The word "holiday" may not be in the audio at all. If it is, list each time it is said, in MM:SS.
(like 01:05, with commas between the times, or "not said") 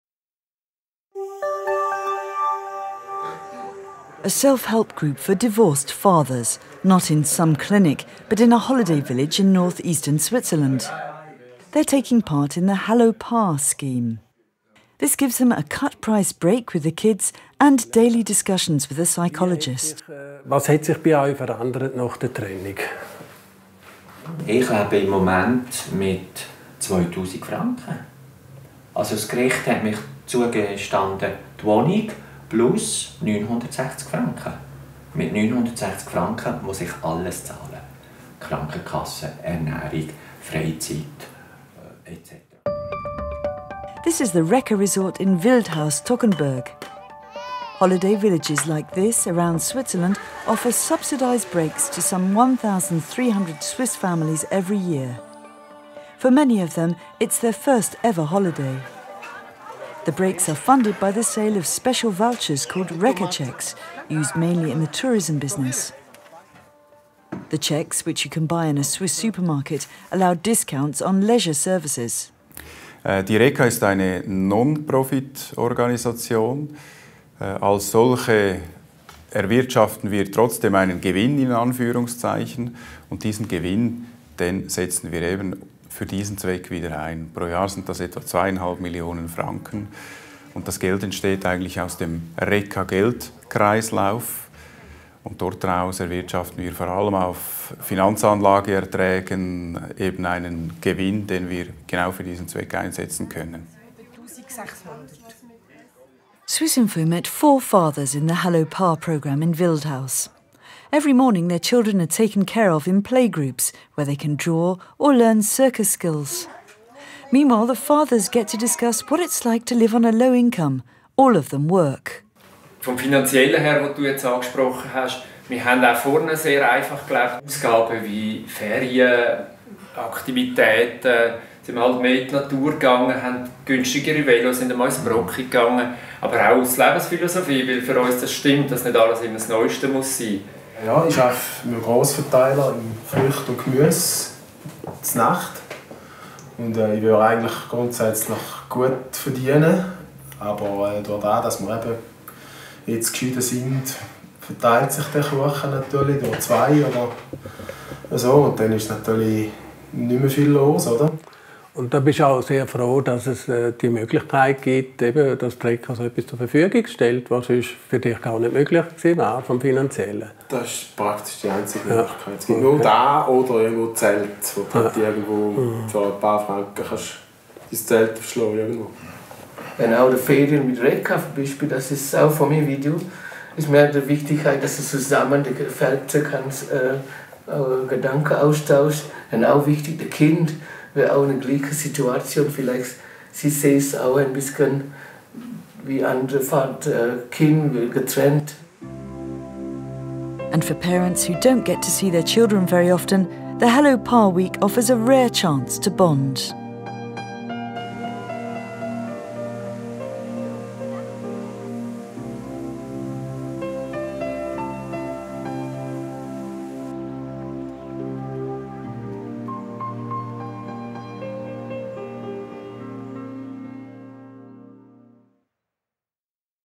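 00:08, 00:47, 00:58.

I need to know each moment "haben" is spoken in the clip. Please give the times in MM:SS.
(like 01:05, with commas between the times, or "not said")
02:05, 02:13.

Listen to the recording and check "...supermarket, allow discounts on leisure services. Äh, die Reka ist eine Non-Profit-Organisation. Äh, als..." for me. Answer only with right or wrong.
right.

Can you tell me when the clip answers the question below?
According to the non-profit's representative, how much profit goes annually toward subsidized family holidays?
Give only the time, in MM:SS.
01:28.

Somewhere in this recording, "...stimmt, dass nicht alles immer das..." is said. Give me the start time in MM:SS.
02:18.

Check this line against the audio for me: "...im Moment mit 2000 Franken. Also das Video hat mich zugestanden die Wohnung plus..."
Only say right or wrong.
wrong.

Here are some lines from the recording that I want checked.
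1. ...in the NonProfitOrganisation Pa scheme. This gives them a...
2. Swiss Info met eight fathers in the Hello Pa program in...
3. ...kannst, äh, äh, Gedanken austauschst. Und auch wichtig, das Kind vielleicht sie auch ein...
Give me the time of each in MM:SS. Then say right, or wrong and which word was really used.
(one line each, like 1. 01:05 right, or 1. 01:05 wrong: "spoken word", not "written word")
1. 00:12 wrong: "Hallo", not "NonProfitOrganisation"
2. 01:46 wrong: "four", not "eight"
3. 03:06 right.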